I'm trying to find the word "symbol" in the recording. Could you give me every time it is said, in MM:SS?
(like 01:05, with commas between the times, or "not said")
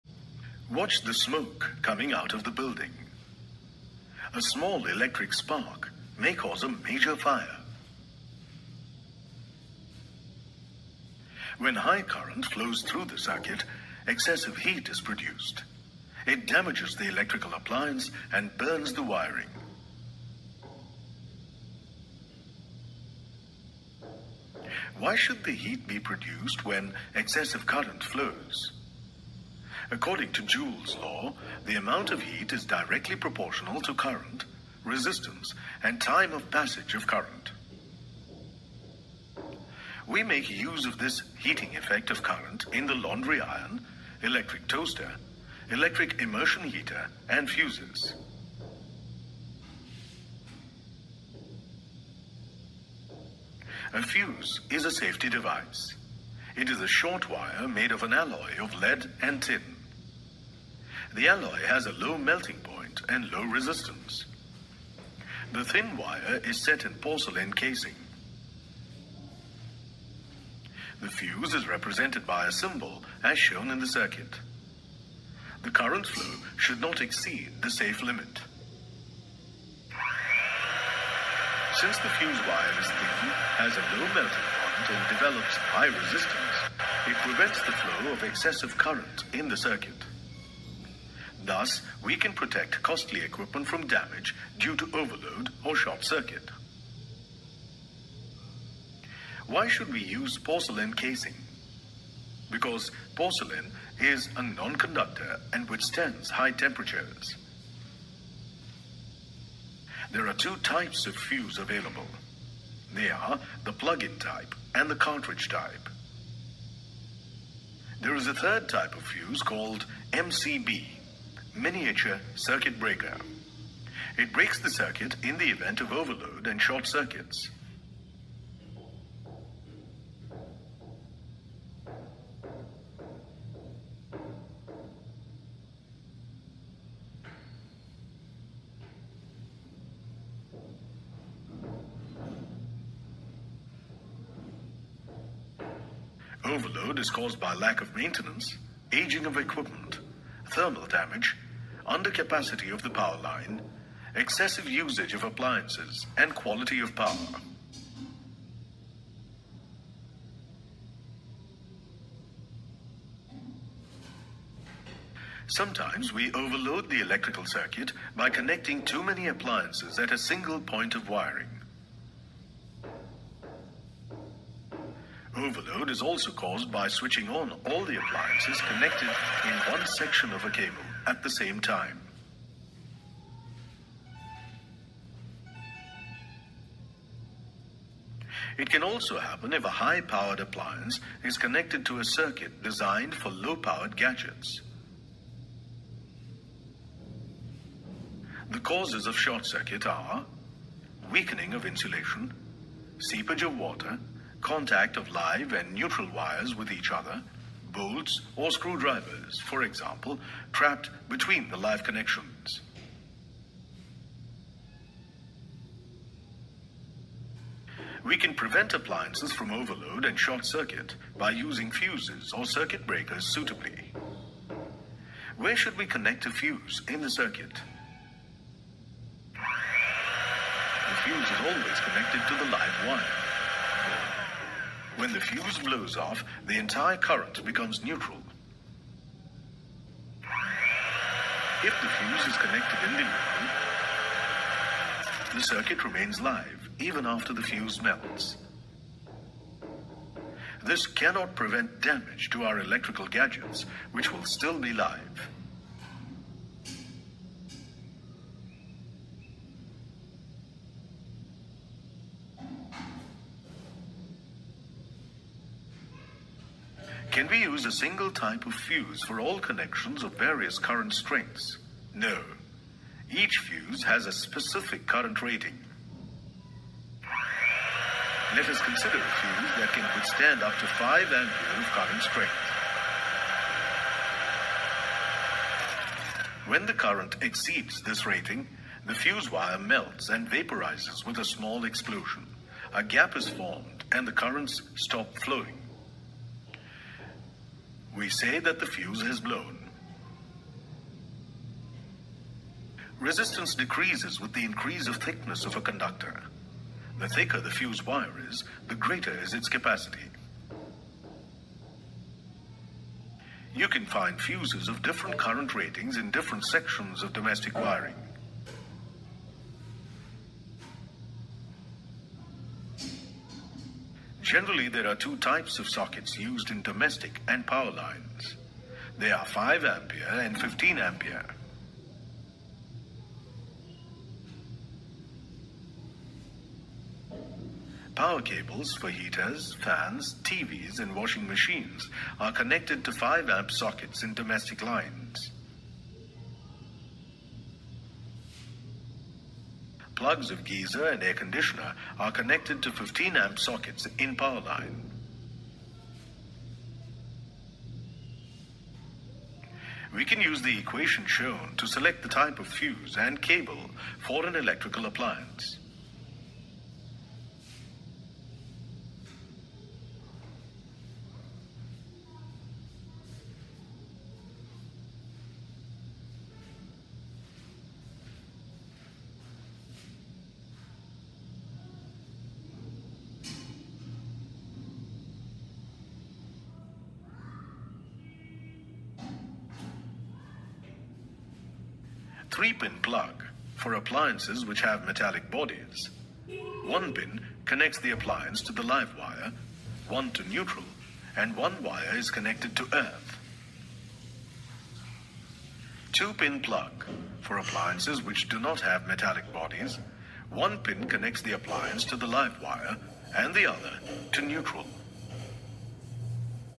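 01:12.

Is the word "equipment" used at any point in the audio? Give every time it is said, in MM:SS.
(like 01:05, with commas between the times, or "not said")
01:33, 02:29.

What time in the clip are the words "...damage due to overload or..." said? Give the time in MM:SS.
01:33.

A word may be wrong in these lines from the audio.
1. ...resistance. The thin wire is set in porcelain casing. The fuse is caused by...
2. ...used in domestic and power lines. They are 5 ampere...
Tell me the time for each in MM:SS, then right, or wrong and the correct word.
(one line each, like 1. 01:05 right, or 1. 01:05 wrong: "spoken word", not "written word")
1. 01:03 wrong: "represented", not "caused"
2. 05:26 right.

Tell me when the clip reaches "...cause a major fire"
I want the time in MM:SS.
00:06.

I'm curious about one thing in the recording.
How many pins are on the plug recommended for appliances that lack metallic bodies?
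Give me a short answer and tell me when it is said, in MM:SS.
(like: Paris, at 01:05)
2, at 06:45.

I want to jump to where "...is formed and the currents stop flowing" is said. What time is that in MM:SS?
04:53.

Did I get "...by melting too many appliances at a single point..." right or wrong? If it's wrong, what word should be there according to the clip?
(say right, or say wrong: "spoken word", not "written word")
wrong: "connecting", not "melting".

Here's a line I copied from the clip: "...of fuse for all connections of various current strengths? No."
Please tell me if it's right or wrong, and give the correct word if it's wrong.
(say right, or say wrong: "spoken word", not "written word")
right.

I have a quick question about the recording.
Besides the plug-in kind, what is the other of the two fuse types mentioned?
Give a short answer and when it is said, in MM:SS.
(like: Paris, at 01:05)
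cartridge type, at 01:54.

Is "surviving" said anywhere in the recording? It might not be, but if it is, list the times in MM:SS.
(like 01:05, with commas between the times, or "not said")
not said.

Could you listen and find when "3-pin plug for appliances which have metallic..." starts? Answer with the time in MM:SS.
06:32.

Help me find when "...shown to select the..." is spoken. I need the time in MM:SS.
06:01.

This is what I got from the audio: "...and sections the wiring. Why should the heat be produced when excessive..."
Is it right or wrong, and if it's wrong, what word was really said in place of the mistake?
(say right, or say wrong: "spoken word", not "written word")
wrong: "burns", not "sections".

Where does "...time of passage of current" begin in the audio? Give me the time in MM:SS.
00:36.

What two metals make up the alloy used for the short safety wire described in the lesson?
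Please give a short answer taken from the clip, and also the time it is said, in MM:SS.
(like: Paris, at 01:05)
lead and tin, at 00:58.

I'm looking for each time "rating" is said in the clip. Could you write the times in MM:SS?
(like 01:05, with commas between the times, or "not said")
04:35, 04:48, 05:15.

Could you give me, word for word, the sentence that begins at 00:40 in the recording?
We make use of this heating effect of current in the laundry iron, electric toaster, electric immersion heater, and fuses.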